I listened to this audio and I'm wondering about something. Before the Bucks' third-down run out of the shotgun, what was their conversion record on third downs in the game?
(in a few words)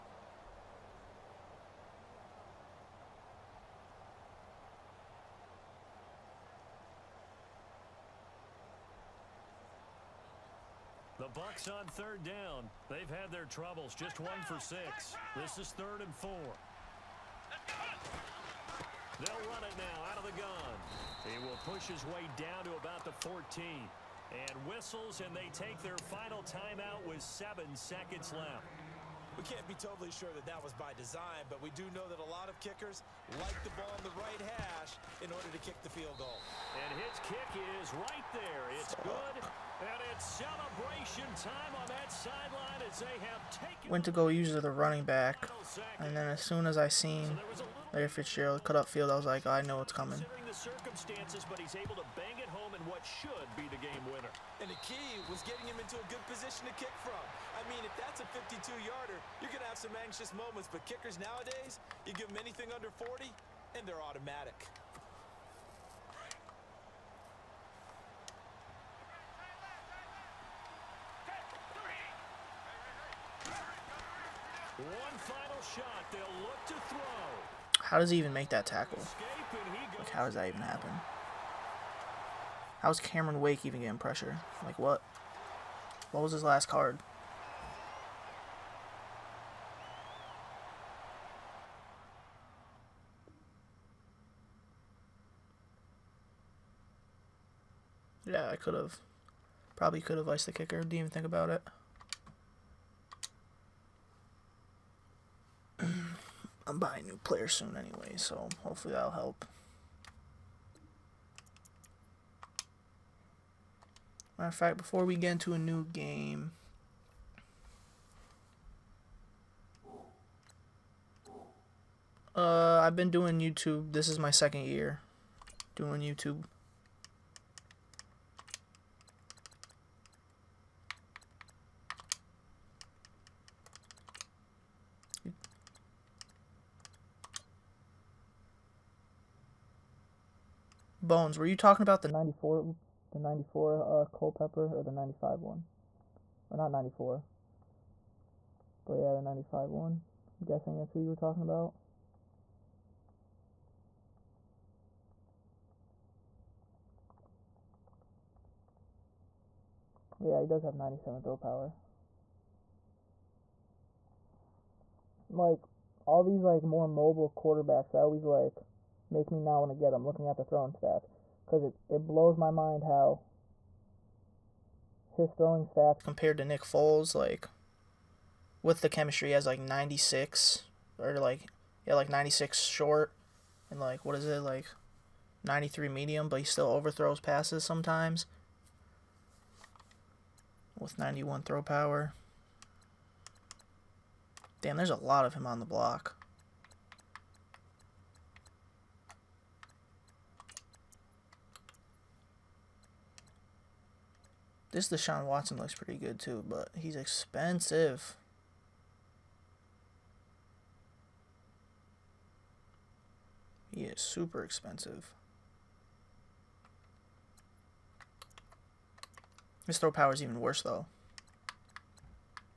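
1 for 6.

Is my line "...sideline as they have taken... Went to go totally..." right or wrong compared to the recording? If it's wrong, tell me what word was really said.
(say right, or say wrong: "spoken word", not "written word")
wrong: "usually", not "totally".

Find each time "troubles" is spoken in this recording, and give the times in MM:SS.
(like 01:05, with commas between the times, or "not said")
00:13.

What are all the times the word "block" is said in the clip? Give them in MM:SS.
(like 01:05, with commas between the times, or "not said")
03:15.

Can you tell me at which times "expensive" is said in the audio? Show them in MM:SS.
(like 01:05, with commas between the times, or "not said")
03:26, 03:34.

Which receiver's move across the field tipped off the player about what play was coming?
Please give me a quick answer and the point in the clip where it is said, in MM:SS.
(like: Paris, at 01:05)
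Larry Fitzgerald, at 00:47.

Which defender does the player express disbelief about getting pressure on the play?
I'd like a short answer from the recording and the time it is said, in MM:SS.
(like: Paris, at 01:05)
Cameron Wake, at 01:22.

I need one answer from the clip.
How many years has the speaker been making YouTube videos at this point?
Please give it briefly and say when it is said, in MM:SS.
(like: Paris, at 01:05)
2, at 02:04.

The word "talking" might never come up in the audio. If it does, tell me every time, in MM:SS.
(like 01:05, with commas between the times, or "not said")
02:21, 02:31.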